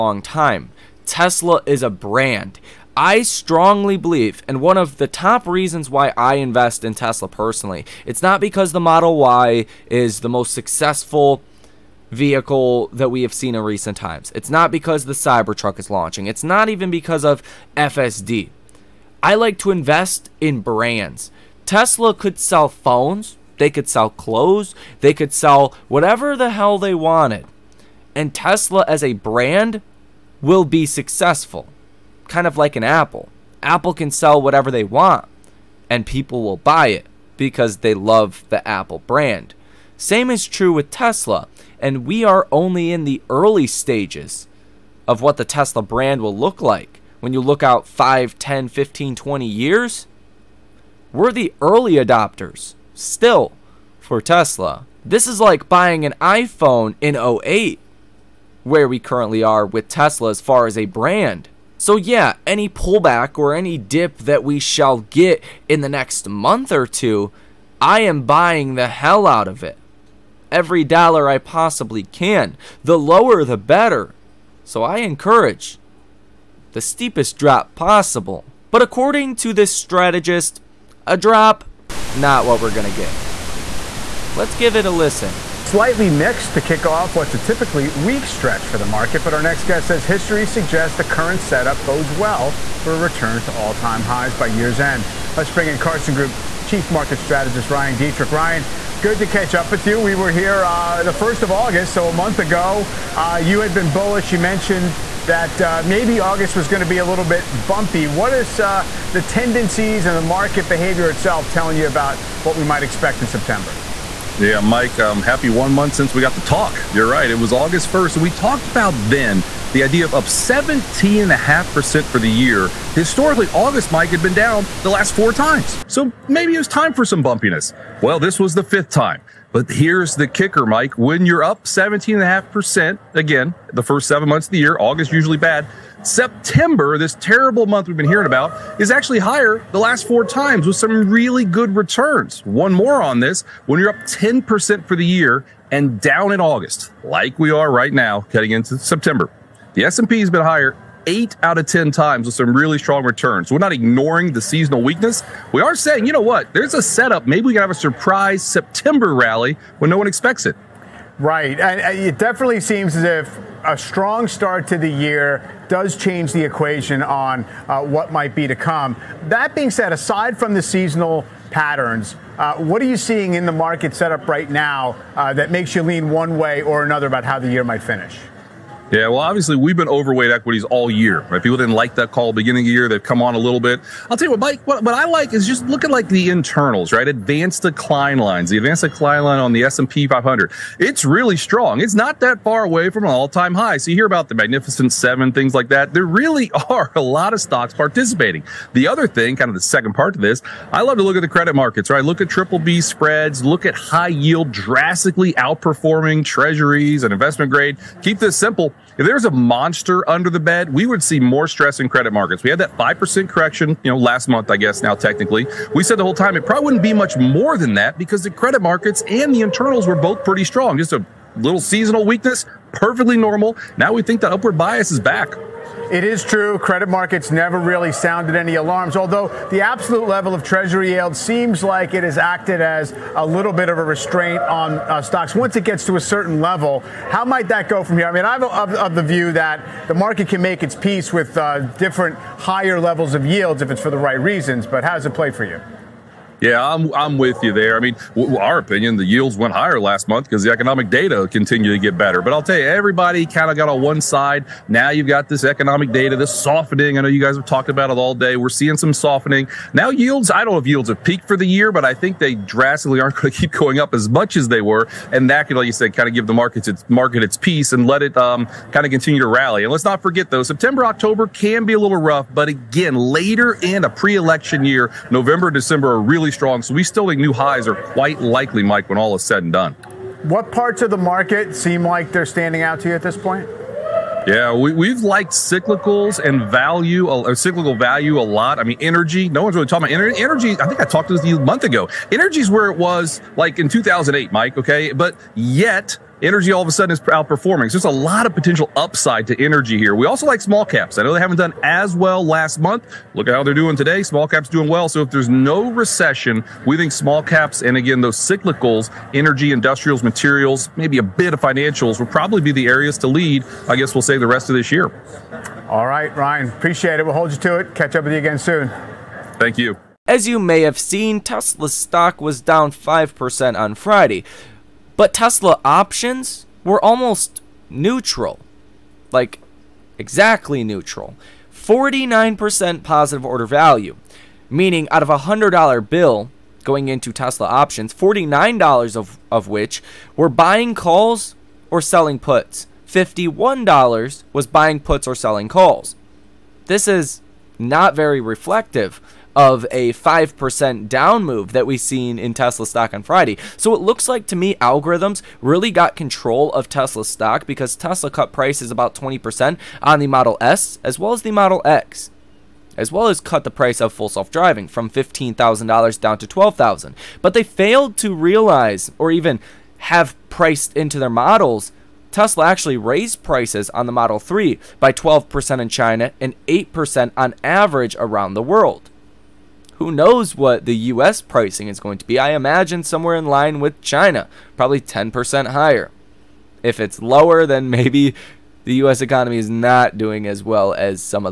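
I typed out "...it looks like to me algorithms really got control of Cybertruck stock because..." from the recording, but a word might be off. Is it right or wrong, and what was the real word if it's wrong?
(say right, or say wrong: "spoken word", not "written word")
wrong: "Tesla", not "Cybertruck".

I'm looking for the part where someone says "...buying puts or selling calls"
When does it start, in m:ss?
5:44.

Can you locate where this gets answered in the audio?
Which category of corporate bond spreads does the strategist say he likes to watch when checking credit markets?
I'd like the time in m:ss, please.
3:22.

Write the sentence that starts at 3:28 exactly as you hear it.
Keep this simple if there was a monster under the bed, we would see more stress in credit markets.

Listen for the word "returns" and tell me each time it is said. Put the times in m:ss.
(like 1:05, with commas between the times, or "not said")
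1:32, 2:21, 2:33.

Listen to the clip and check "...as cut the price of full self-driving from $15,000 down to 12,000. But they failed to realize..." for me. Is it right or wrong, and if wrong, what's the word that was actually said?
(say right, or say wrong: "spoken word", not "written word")
right.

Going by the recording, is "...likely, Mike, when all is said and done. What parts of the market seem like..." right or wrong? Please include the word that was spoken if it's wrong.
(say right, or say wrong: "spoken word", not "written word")
right.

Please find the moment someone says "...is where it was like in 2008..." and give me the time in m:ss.
4:52.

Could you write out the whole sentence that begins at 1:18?
But according to this strategist, a drop, not what we're going to get.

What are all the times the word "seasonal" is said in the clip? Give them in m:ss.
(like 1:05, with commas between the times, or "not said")
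2:34, 2:50, 3:41.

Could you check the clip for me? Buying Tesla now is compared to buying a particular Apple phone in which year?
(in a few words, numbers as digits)
2008.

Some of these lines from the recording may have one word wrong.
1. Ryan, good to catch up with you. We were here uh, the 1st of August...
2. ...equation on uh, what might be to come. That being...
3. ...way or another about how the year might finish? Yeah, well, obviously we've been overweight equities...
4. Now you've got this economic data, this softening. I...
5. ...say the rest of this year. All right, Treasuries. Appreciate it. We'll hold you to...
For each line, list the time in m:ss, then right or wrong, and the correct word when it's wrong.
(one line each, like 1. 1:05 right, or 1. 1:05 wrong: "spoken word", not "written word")
1. 1:38 right
2. 2:46 right
3. 2:56 right
4. 4:14 right
5. 5:14 wrong: "Ryan", not "Treasuries".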